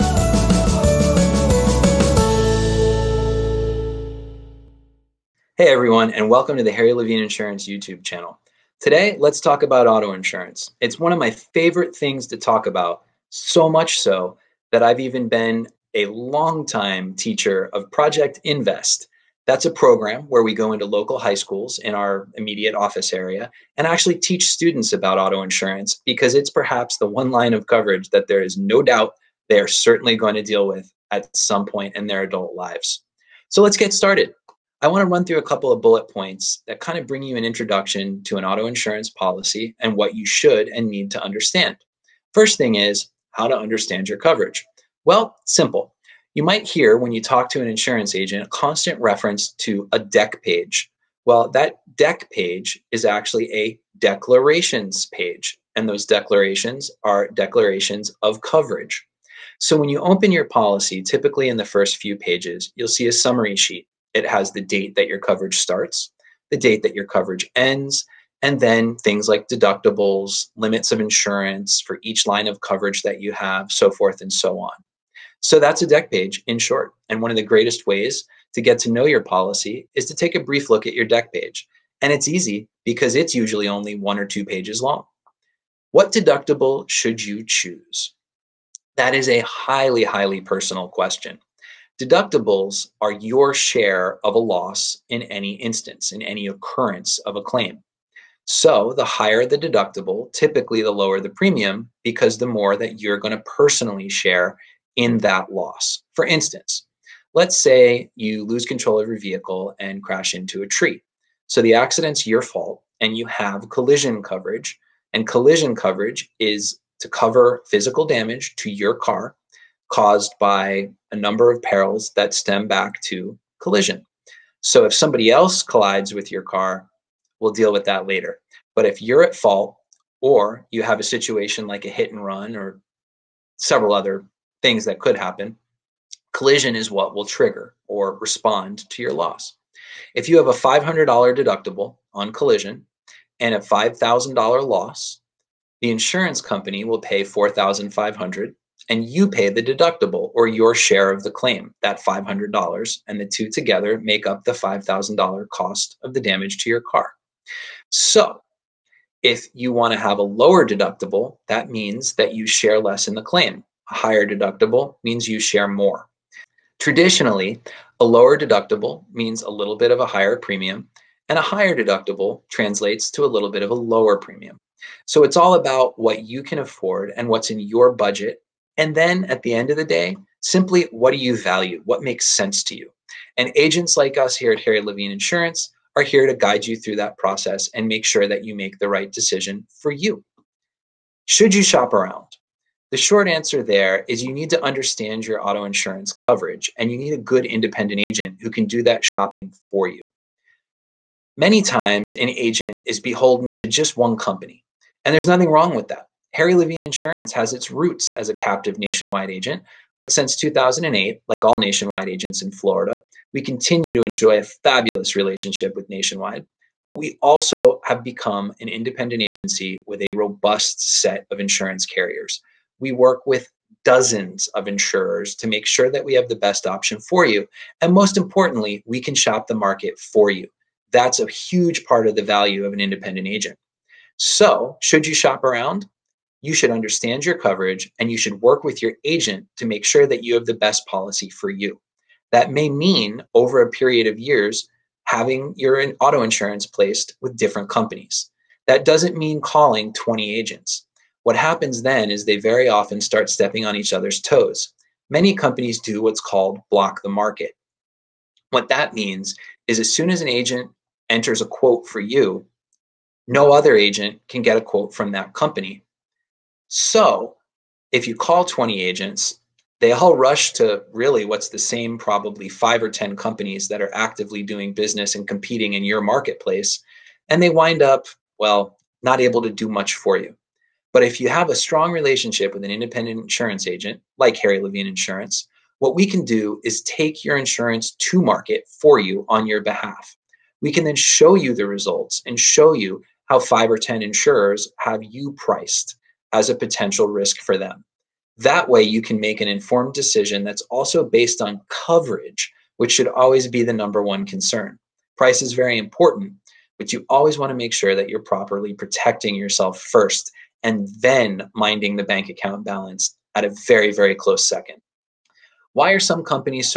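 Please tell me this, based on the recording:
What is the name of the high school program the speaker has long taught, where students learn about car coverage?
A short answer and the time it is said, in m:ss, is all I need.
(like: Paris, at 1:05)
Project Invest, at 0:17.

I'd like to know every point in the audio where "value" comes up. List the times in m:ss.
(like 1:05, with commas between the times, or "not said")
3:01, 3:52.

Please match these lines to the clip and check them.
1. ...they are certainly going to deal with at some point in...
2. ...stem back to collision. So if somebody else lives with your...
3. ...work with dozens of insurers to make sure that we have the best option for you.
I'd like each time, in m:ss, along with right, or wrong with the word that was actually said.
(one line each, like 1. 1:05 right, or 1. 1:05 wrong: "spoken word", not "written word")
1. 0:29 right
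2. 2:02 wrong: "collides", not "lives"
3. 3:42 right.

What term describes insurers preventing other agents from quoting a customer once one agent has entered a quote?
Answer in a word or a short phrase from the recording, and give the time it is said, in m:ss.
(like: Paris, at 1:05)
block the market, at 4:16.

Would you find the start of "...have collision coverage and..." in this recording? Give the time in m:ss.
1:53.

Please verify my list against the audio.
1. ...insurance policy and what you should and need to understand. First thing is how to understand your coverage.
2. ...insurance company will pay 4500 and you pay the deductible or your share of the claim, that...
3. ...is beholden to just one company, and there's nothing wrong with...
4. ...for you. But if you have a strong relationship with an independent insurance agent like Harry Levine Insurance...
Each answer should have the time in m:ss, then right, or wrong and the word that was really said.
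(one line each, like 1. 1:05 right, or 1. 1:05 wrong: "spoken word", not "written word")
1. 0:38 right
2. 2:25 right
3. 3:22 right
4. 4:39 right.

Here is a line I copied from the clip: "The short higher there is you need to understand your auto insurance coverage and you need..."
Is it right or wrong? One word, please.
wrong.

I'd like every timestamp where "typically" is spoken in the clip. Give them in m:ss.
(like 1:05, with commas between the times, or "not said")
1:01, 1:40.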